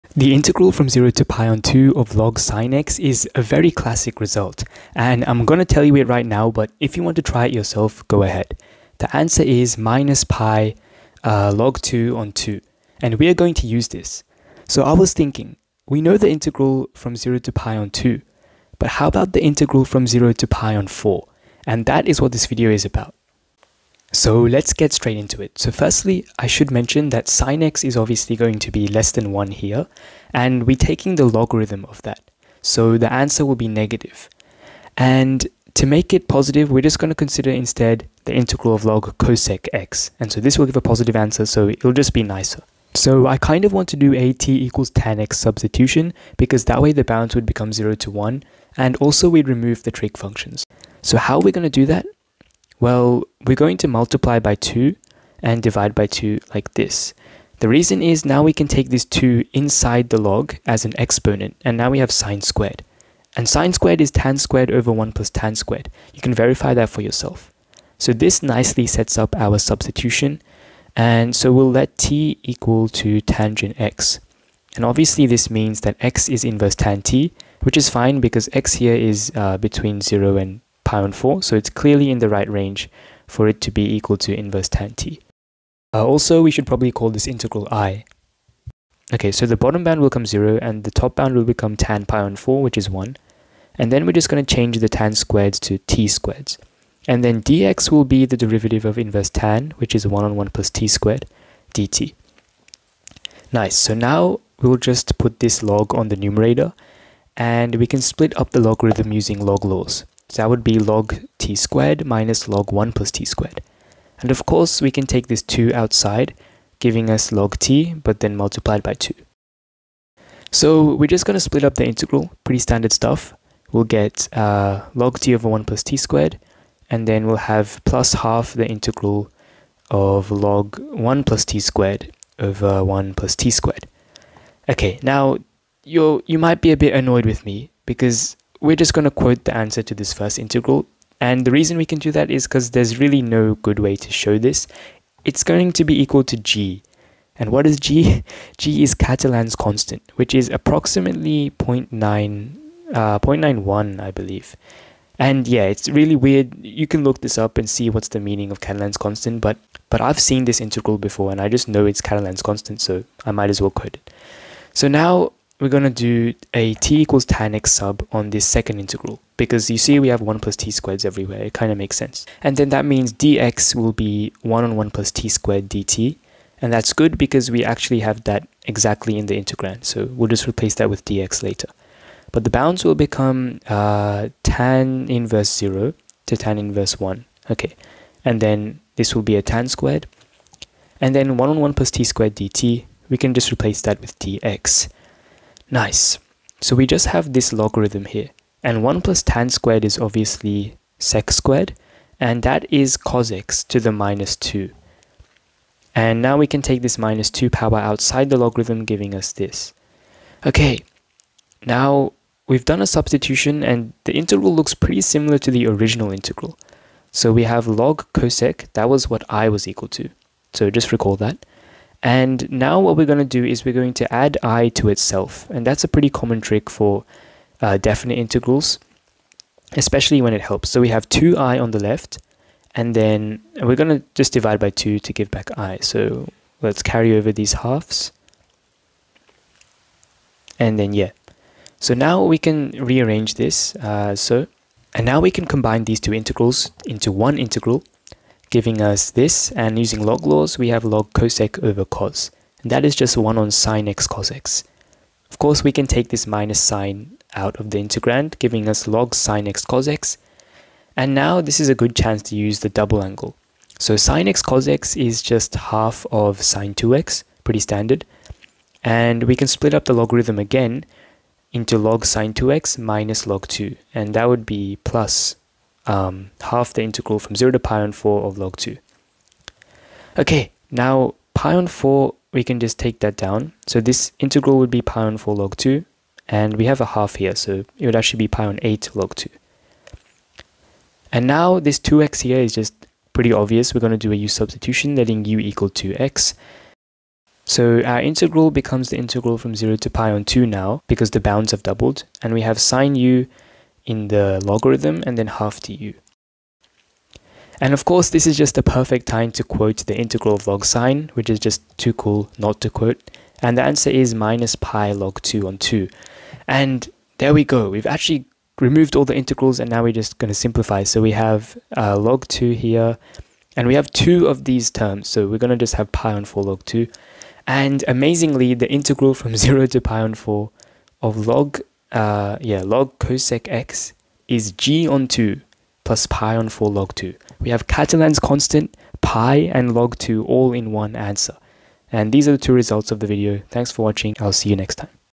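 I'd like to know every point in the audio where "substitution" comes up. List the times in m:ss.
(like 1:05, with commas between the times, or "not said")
0:45, 1:09, 3:32, 4:54.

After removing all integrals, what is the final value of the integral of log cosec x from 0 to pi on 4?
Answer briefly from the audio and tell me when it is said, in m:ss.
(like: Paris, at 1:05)
G/2 + (pi/4) log 2, at 5:34.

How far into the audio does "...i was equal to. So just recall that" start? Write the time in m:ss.
3:39.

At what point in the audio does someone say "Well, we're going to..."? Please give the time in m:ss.
0:52.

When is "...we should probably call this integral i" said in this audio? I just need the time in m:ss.
1:26.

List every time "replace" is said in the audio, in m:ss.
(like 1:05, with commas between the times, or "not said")
3:00, 3:13.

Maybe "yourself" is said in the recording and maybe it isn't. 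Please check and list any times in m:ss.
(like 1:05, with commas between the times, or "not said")
0:07, 1:07.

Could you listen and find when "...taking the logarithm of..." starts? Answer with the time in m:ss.
0:30.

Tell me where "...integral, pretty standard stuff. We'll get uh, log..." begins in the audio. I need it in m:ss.
2:01.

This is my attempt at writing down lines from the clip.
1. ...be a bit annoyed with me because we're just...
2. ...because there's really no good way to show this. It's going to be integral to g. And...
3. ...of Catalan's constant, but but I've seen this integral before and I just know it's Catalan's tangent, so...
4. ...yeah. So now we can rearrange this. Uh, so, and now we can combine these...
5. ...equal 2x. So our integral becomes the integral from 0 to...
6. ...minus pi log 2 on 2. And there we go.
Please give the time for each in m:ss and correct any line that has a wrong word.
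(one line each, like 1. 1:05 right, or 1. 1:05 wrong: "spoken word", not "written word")
1. 2:16 right
2. 2:22 wrong: "equal", not "integral"
3. 2:38 wrong: "constant", not "tangent"
4. 4:00 right
5. 4:55 right
6. 5:14 right.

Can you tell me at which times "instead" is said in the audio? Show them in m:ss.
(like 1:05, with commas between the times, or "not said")
0:37.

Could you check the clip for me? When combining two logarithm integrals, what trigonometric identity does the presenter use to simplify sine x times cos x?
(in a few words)
double angle.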